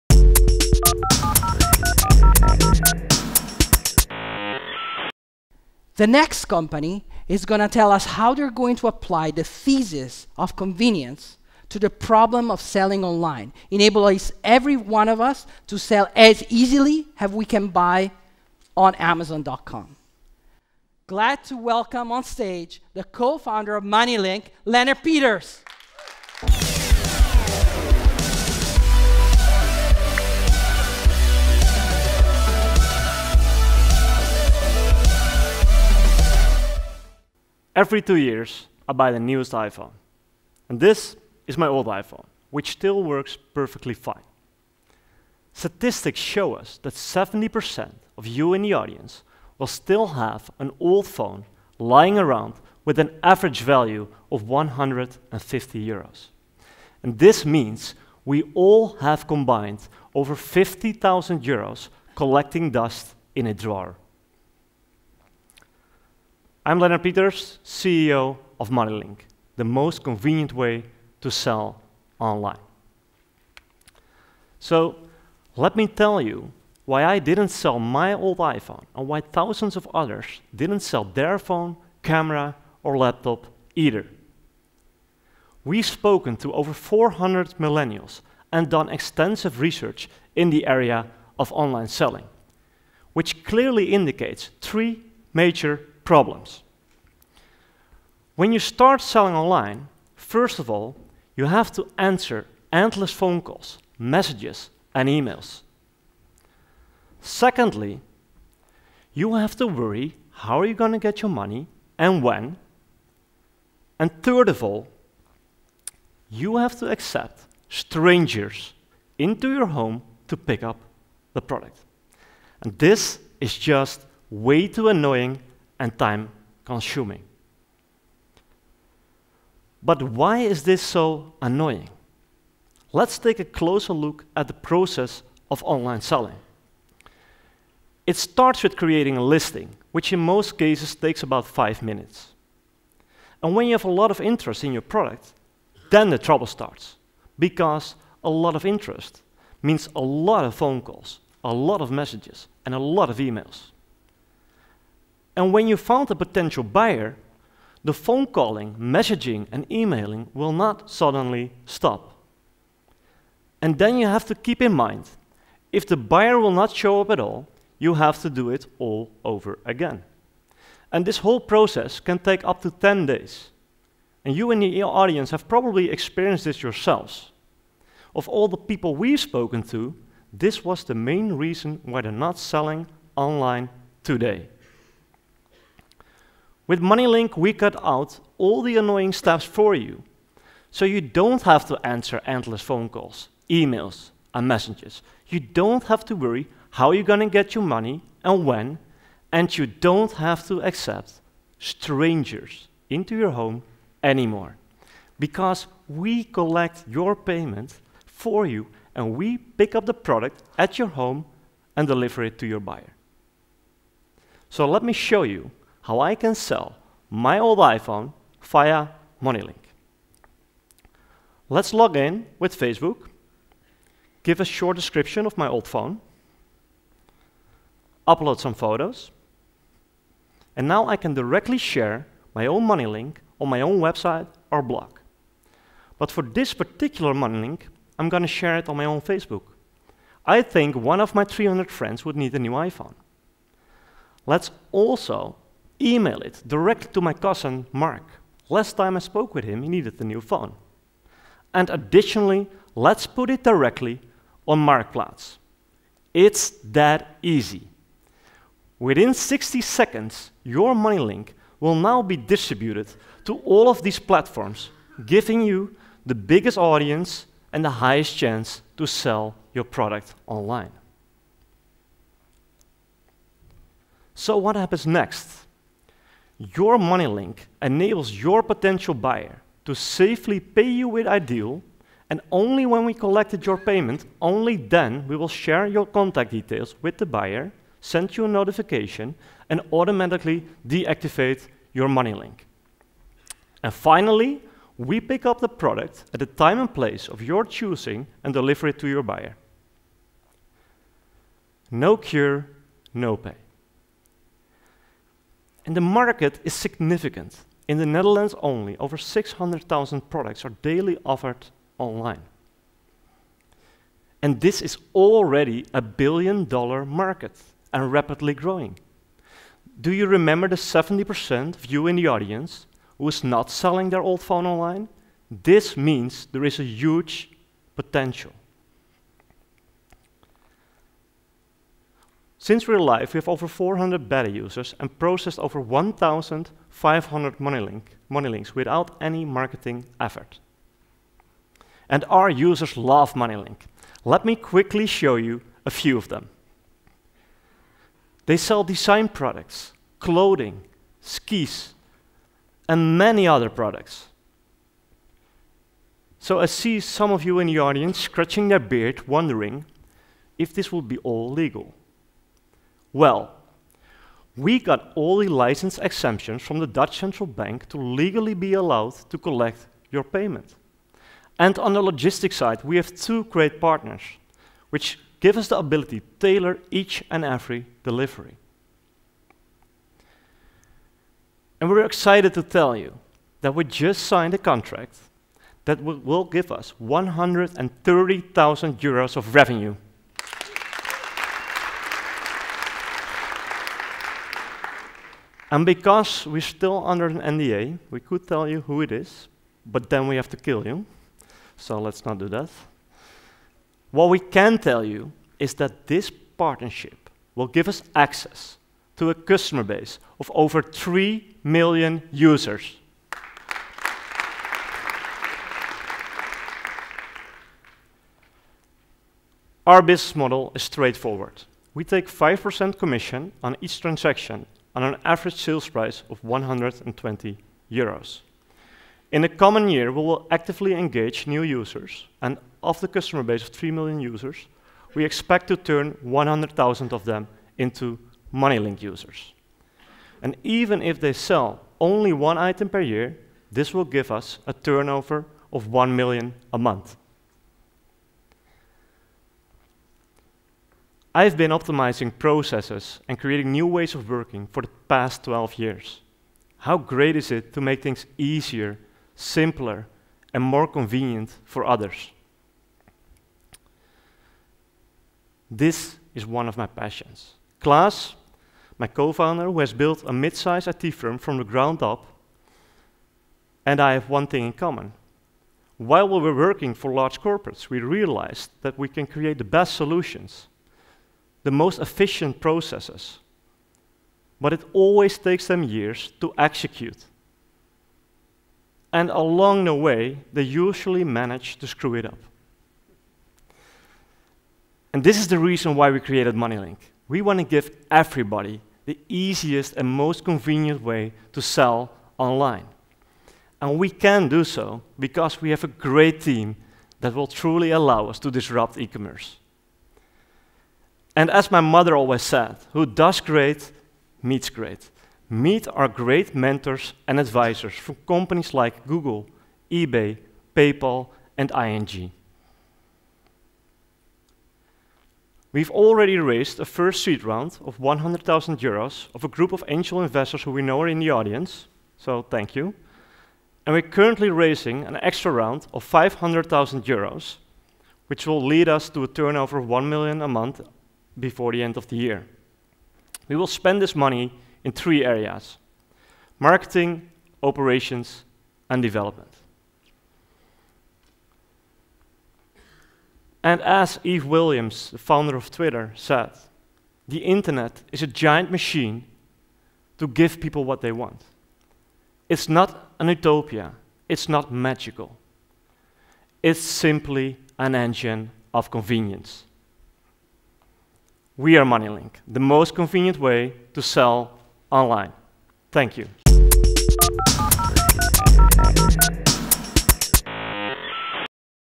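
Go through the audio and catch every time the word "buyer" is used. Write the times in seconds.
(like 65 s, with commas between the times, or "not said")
156 s, 165 s, 212 s, 278 s, 287 s, 299 s.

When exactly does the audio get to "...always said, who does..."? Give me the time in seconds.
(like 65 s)
511 s.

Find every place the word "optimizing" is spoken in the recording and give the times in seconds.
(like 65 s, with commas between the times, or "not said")
451 s.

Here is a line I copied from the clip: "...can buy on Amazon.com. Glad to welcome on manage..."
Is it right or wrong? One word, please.
wrong.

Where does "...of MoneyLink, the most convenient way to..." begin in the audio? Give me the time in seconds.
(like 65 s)
68 s.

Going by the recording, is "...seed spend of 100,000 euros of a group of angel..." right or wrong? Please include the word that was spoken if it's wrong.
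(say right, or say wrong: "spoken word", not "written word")
wrong: "round", not "spend".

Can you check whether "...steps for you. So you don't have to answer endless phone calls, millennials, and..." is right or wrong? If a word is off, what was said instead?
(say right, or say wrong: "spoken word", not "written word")
wrong: "emails", not "millennials".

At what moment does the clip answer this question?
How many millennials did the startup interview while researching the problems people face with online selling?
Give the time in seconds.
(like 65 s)
86 s.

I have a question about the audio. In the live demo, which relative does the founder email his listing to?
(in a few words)
Mark.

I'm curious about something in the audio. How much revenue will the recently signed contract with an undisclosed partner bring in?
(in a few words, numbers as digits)
130,000 euros.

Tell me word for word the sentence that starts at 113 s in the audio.
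And third of all, you have to accept strangers into your home to pick up the product.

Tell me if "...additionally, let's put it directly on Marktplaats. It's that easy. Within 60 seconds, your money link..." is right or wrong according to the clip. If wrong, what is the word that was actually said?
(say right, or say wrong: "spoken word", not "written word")
right.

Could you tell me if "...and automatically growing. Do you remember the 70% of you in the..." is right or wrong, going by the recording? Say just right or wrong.
wrong.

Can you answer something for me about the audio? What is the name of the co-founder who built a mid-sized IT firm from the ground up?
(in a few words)
Klaas.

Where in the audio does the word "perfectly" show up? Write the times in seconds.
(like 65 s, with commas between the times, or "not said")
43 s.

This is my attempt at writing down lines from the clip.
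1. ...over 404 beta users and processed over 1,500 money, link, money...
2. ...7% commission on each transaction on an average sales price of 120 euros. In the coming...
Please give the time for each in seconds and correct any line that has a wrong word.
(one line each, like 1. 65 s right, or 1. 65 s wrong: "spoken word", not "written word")
1. 333 s wrong: "400", not "404"
2. 422 s wrong: "5", not "7".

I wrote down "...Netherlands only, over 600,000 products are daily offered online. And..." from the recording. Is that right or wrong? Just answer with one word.
right.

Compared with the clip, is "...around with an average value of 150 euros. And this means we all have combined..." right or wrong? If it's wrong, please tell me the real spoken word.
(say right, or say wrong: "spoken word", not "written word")
right.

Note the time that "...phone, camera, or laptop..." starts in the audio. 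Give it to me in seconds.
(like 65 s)
81 s.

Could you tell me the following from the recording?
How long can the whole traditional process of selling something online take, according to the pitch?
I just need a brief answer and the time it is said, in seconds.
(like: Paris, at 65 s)
10 days, at 172 s.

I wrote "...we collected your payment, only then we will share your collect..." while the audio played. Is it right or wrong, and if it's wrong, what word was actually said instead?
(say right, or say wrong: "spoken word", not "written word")
wrong: "contact", not "collect".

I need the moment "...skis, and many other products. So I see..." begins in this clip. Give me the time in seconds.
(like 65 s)
350 s.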